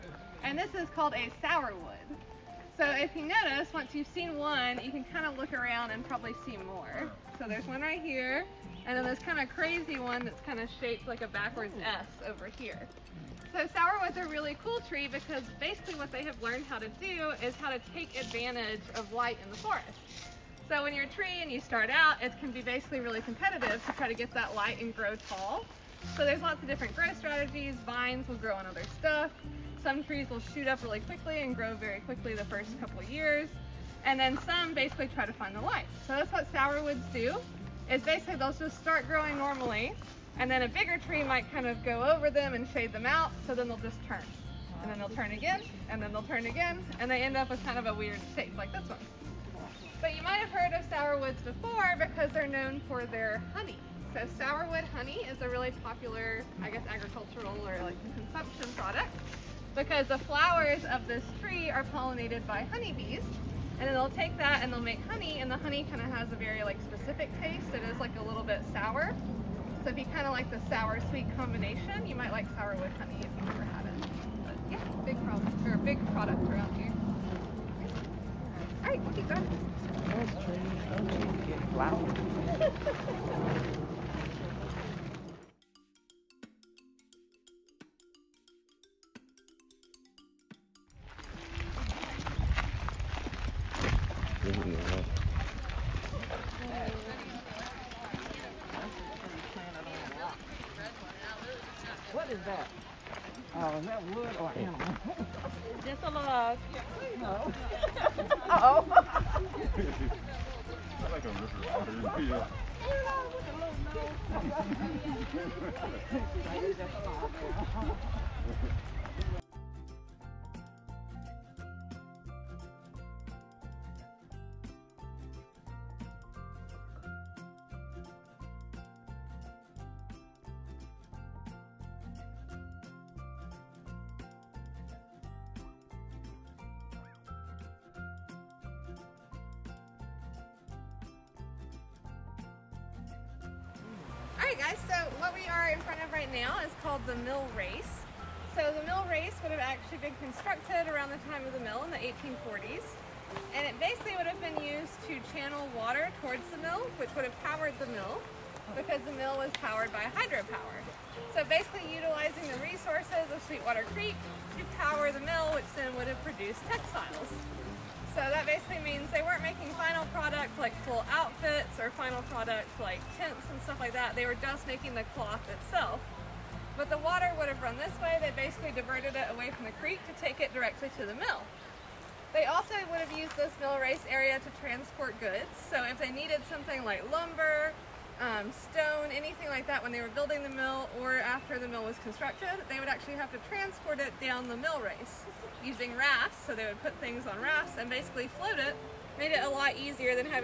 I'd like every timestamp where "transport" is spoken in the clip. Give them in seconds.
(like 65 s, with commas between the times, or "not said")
184 s, 193 s.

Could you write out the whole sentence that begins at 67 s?
It is like a little bit sour.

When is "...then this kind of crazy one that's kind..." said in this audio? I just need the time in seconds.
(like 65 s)
8 s.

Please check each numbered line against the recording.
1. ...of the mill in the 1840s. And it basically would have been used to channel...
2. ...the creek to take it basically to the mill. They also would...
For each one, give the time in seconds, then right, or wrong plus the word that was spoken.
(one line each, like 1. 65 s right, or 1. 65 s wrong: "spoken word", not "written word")
1. 151 s right
2. 179 s wrong: "directly", not "basically".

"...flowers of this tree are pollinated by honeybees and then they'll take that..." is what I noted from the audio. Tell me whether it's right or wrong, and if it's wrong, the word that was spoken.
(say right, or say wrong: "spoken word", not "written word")
right.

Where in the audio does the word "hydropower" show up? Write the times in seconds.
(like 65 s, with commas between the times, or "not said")
160 s.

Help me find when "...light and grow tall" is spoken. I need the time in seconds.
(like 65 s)
24 s.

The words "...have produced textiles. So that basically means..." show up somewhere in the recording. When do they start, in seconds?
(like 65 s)
166 s.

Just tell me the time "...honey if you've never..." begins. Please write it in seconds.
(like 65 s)
72 s.